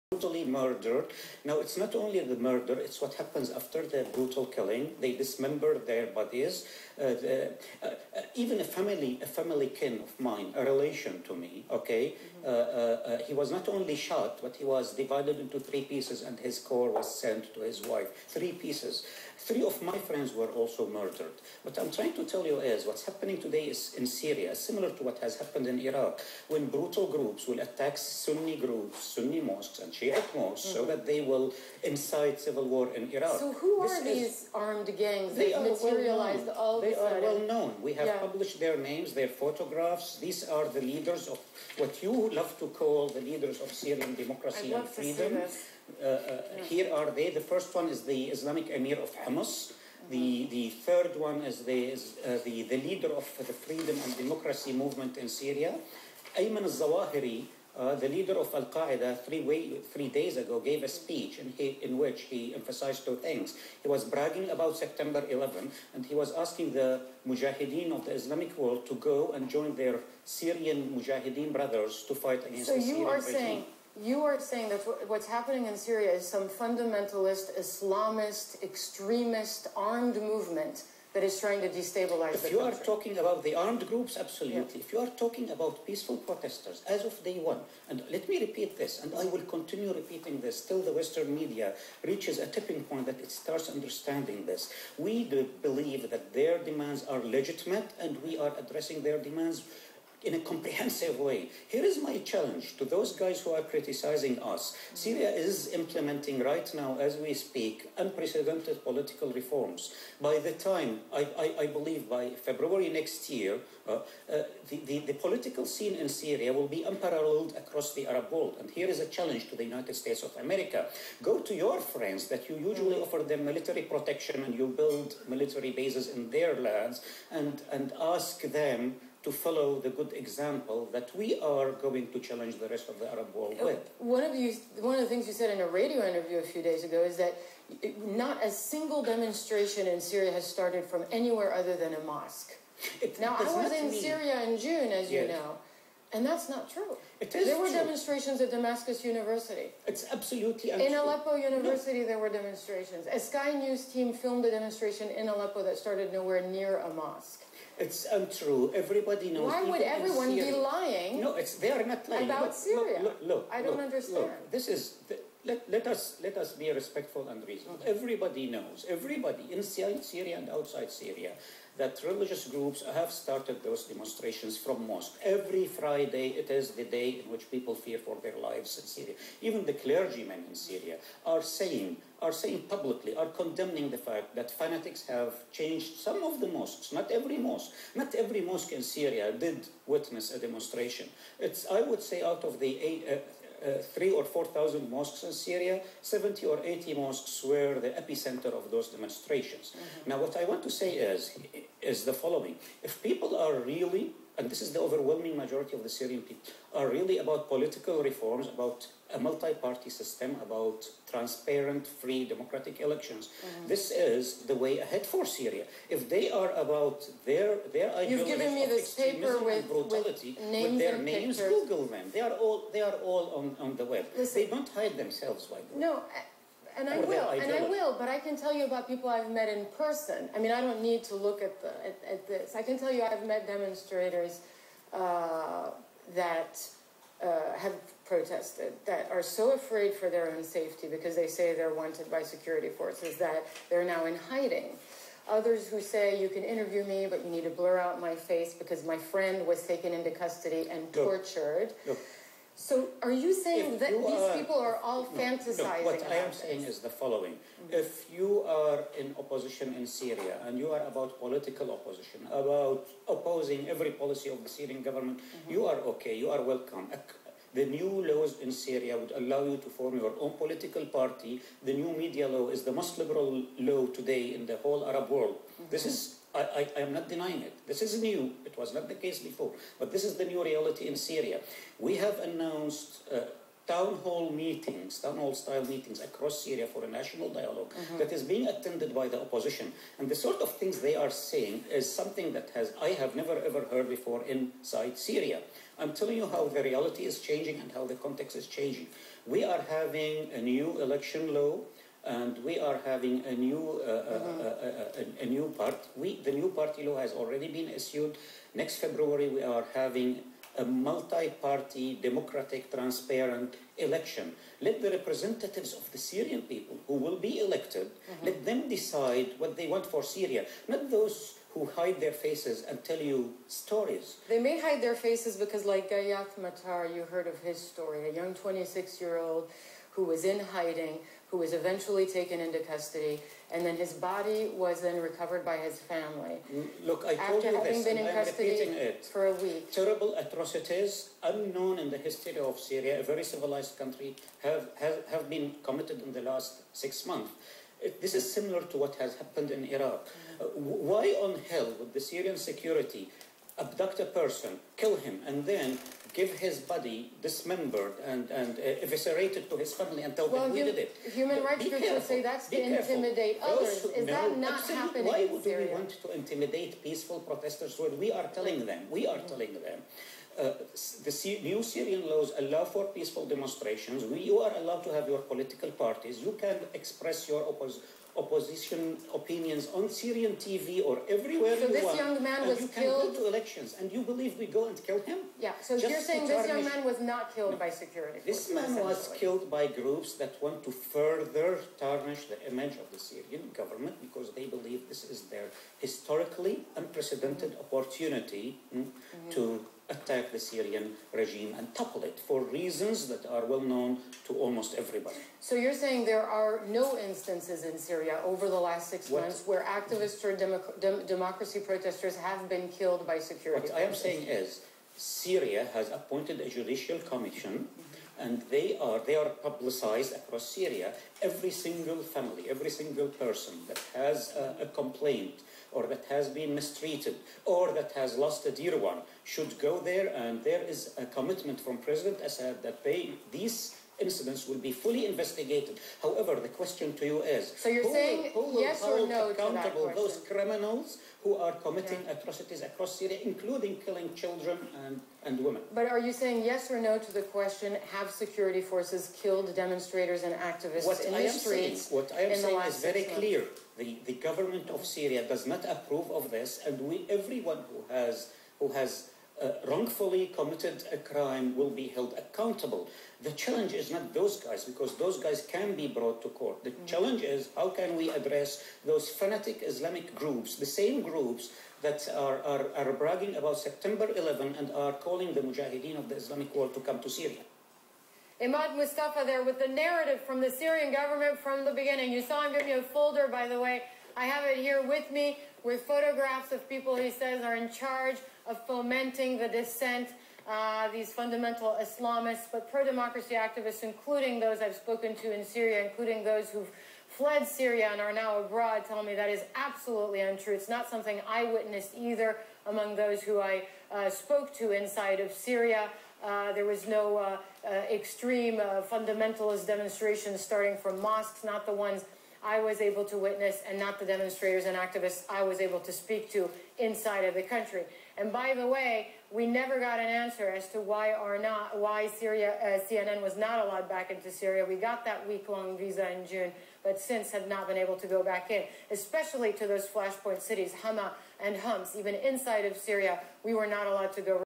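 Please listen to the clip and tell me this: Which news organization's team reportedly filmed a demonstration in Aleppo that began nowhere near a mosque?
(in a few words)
Sky News.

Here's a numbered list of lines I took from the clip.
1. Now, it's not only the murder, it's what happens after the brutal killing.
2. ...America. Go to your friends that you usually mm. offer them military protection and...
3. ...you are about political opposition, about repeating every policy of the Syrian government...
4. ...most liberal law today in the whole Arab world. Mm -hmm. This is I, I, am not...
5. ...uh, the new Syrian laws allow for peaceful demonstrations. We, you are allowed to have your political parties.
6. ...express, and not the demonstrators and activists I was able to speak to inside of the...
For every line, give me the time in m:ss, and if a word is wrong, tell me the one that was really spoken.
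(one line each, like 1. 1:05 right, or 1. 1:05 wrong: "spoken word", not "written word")
1. 0:01 right
2. 2:00 right
3. 4:20 wrong: "opposing", not "repeating"
4. 4:32 right
5. 6:10 right
6. 8:33 wrong: "witness", not "express".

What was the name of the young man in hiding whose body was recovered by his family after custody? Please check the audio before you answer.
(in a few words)
Gayath Matar.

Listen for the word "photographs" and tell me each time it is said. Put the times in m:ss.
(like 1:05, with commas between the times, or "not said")
0:39, 8:05.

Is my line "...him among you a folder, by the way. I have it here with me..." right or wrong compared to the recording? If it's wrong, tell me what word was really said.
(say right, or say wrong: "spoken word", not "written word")
wrong: "giving", not "among".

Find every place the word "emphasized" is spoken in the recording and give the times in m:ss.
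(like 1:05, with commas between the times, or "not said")
1:02.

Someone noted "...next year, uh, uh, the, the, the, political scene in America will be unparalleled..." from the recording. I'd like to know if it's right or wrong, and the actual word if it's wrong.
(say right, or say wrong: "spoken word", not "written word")
wrong: "Syria", not "America".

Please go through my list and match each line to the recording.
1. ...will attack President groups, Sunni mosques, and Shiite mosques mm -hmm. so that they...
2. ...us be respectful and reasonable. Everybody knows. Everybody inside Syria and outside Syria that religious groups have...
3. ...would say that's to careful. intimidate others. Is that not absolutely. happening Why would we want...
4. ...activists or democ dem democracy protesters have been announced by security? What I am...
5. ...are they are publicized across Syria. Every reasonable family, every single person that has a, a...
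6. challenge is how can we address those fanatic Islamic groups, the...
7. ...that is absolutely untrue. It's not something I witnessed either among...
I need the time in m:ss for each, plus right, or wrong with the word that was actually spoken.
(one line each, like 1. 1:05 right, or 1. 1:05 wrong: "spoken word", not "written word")
1. 0:27 wrong: "Sunni", not "President"
2. 2:46 right
3. 6:01 right
4. 6:49 wrong: "killed", not "announced"
5. 6:58 wrong: "single", not "reasonable"
6. 7:46 right
7. 8:19 right.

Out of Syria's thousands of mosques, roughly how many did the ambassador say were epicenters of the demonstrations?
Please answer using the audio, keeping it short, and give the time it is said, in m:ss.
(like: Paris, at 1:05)
70 or 80, at 3:16.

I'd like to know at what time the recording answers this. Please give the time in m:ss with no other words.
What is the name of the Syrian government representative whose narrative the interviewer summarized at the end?
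7:58.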